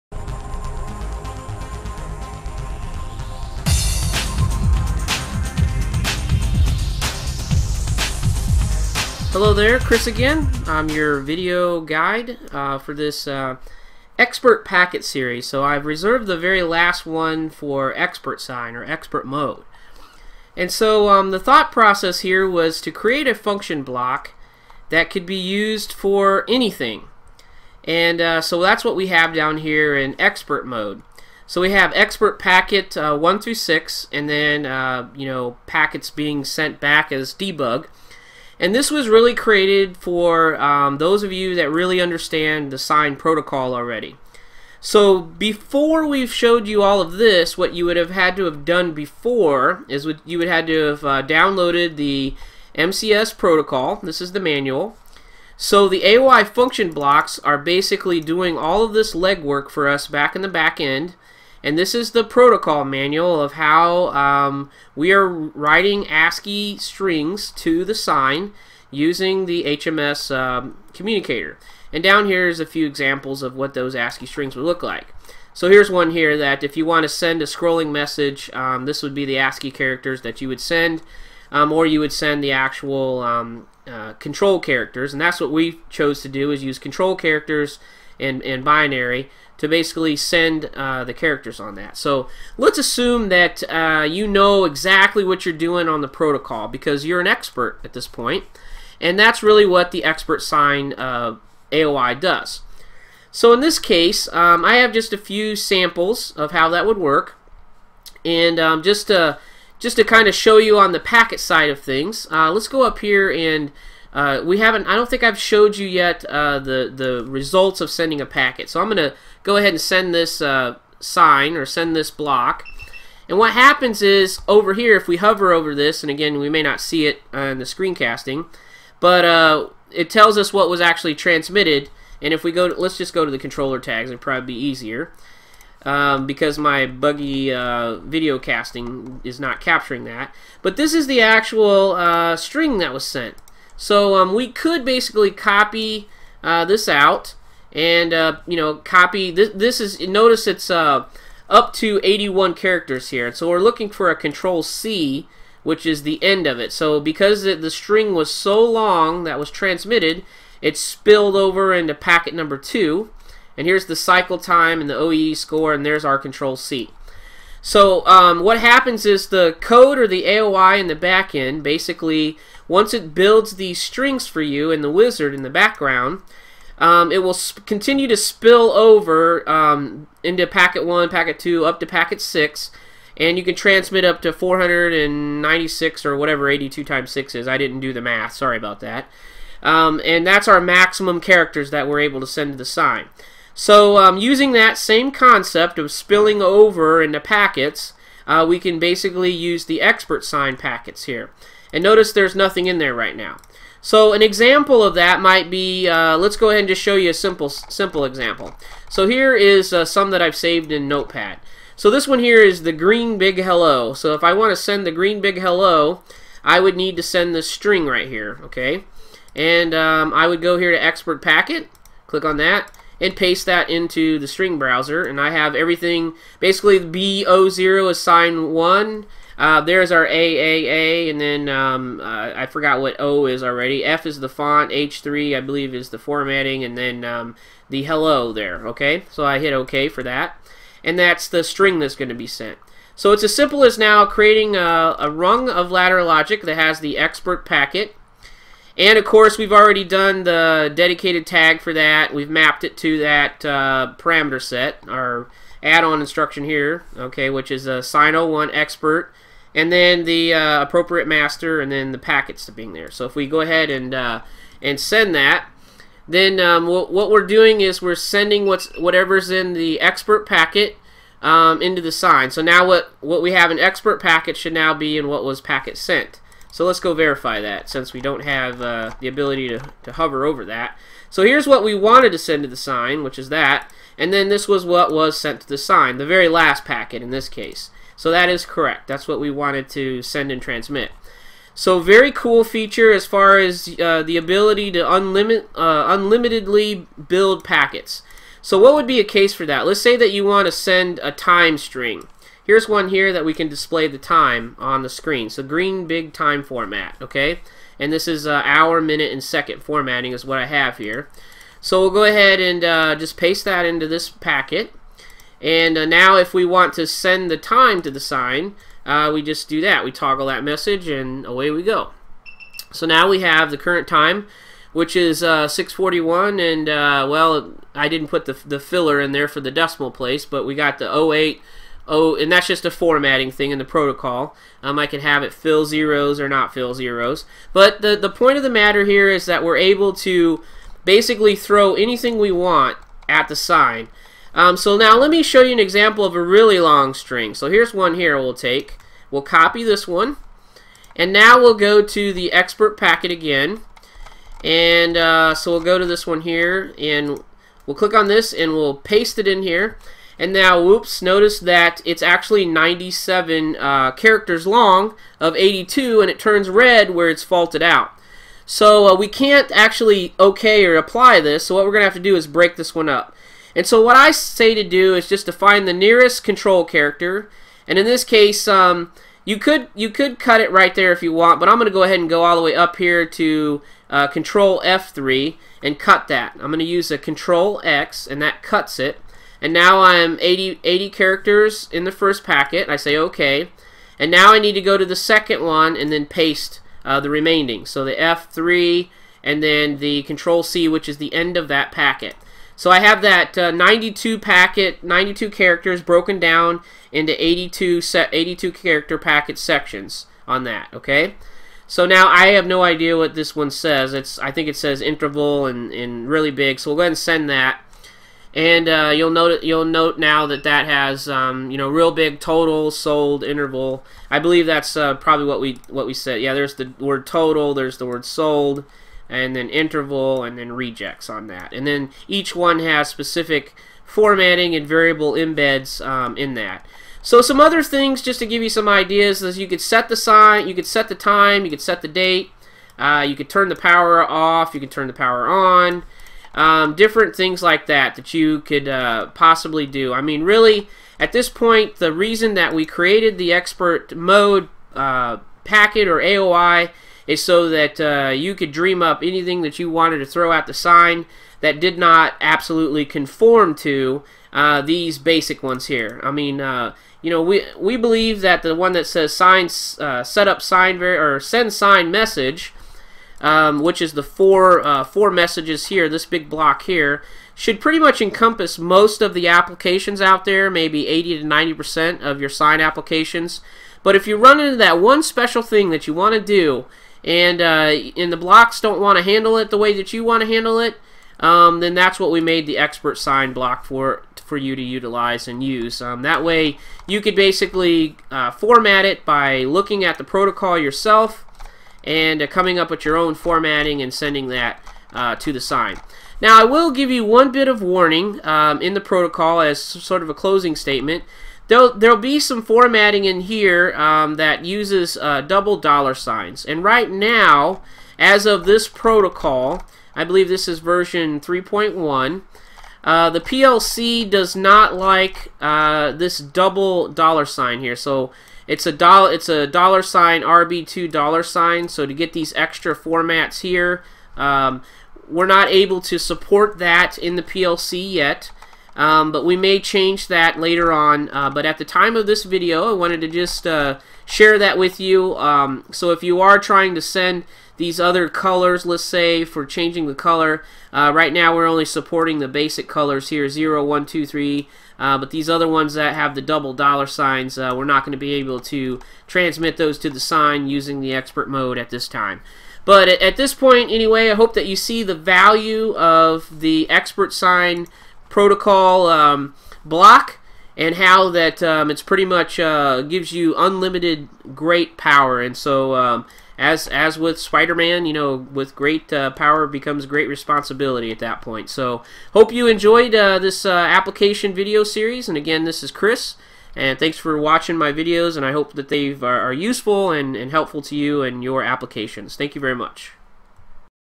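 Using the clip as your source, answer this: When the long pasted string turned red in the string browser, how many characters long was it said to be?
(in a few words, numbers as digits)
97.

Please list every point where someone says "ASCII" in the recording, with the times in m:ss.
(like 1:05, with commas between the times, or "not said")
1:06, 1:13, 1:19.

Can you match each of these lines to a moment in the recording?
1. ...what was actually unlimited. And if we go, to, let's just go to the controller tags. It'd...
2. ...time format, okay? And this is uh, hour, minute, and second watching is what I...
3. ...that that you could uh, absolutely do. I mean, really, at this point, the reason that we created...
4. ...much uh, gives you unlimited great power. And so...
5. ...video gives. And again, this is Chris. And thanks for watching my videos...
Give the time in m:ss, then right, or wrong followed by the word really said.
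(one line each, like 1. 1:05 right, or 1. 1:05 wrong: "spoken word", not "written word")
1. 2:10 wrong: "transmitted", not "unlimited"
2. 5:06 wrong: "formatting", not "watching"
3. 7:27 wrong: "possibly", not "absolutely"
4. 9:32 right
5. 9:44 wrong: "series", not "gives".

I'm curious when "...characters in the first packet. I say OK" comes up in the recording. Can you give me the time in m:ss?
6:30.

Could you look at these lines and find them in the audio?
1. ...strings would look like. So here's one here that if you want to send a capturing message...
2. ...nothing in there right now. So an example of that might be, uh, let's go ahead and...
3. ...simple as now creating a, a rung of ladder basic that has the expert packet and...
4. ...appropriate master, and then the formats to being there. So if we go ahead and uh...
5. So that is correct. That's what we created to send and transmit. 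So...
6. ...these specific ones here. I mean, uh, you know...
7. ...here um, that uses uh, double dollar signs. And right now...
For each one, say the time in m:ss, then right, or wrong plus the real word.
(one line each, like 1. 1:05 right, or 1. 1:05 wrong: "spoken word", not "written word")
1. 1:14 wrong: "scrolling", not "capturing"
2. 3:22 right
3. 4:03 wrong: "logic", not "basic"
4. 4:20 wrong: "packets", not "formats"
5. 4:47 wrong: "wanted", not "created"
6. 7:44 wrong: "basic", not "specific"
7. 8:33 right.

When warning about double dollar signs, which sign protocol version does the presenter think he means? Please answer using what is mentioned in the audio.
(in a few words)
3.1.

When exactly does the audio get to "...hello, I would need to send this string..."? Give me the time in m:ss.
3:35.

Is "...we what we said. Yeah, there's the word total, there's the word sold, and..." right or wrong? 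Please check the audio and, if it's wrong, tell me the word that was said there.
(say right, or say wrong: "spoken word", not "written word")
right.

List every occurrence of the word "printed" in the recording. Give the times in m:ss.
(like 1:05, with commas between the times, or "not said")
not said.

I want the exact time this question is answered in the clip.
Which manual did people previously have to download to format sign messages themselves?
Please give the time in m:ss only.
0:52.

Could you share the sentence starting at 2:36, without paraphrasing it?
So because the string was so long that was transmitted, it spilled over into packet number two.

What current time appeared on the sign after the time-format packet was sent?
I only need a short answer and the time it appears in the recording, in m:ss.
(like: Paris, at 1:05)
641, at 5:25.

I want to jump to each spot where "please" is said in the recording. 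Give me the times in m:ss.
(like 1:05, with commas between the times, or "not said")
not said.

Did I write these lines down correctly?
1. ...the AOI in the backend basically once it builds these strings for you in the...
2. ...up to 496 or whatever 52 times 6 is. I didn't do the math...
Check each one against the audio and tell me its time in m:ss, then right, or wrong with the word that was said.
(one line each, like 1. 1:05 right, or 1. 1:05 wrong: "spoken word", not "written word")
1. 2:50 right
2. 3:04 wrong: "82", not "52".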